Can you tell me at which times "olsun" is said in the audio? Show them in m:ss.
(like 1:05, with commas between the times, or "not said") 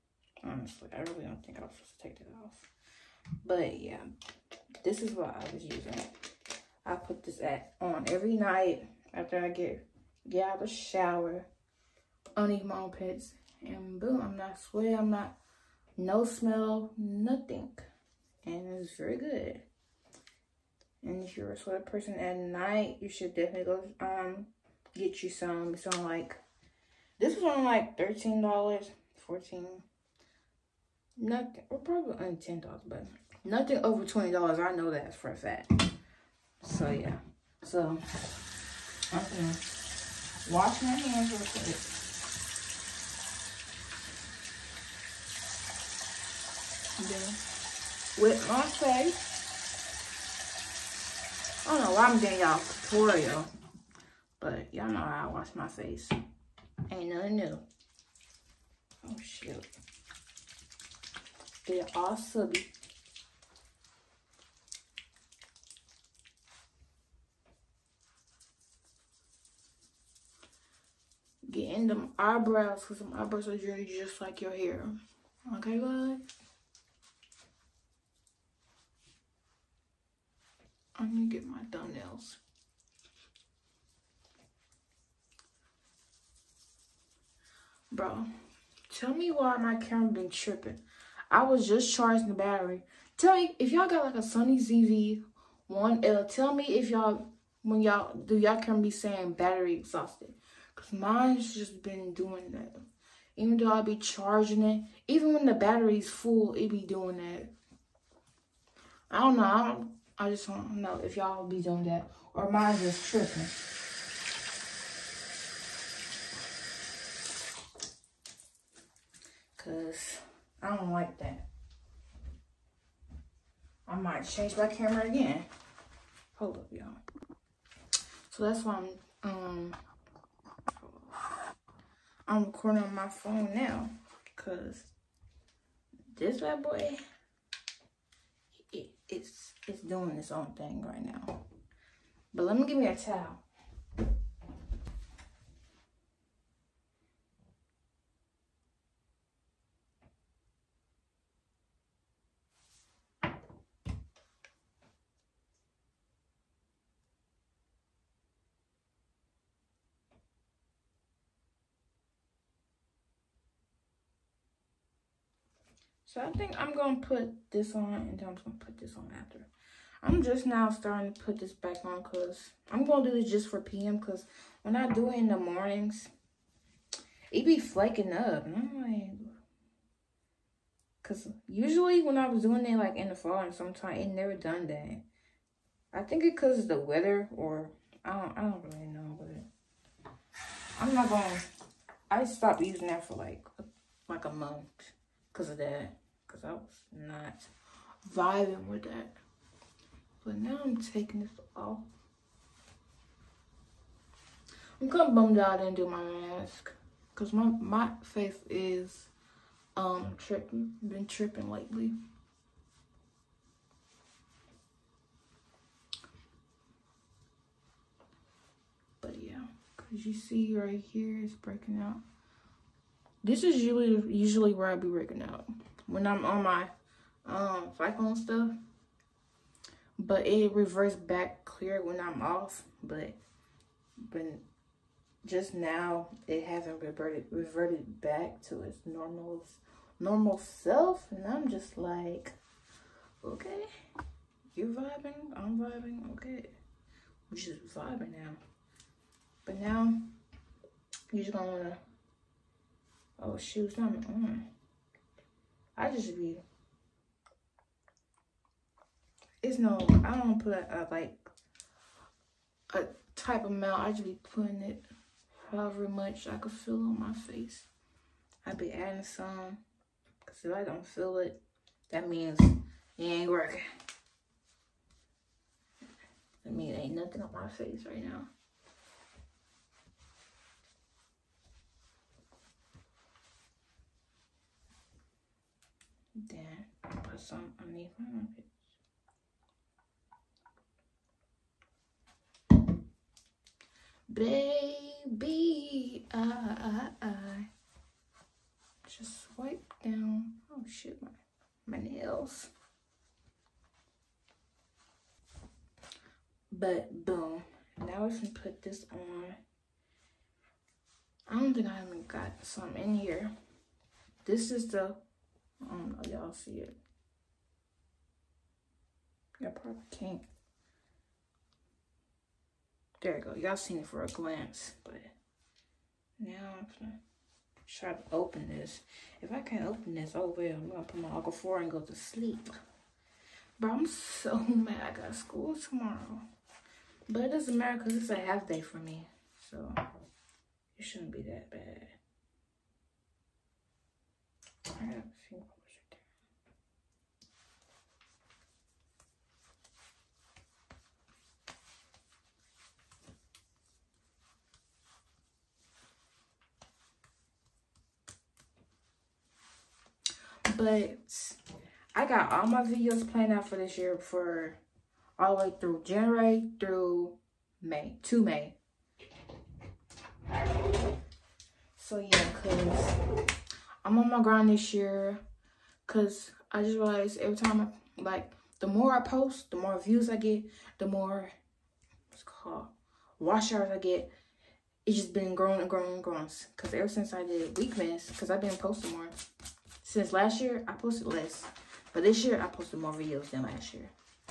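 4:47.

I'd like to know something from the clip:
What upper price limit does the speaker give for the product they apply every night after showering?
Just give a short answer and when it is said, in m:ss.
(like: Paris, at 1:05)
$20, at 0:34.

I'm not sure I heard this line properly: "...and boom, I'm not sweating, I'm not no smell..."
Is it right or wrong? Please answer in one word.
right.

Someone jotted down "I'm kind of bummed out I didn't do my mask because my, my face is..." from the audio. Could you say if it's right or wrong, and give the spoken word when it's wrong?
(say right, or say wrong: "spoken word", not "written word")
right.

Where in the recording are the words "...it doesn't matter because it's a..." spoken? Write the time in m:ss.
5:37.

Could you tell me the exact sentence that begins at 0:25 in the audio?
It's on like this was on like thirteen dollars, fourteen.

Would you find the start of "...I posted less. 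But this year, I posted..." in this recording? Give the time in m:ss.
6:30.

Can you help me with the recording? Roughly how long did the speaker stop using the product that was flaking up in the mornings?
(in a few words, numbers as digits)
a month.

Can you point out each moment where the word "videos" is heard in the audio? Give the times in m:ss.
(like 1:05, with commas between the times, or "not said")
6:02, 6:32.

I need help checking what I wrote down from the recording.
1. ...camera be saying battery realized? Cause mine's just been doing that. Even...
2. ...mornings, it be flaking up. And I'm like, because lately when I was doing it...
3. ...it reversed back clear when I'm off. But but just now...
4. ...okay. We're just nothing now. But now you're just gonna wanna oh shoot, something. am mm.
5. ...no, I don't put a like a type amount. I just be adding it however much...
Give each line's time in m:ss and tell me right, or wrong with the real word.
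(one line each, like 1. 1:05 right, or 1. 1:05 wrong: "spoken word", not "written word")
1. 1:38 wrong: "exhausted", not "realized"
2. 2:55 wrong: "usually", not "lately"
3. 3:50 right
4. 4:06 wrong: "vibing", not "nothing"
5. 4:19 wrong: "putting", not "adding".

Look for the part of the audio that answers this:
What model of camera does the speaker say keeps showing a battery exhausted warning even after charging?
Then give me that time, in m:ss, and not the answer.
1:34.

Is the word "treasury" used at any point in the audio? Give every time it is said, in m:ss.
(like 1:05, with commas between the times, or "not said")
not said.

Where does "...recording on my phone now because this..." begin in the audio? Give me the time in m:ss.
2:12.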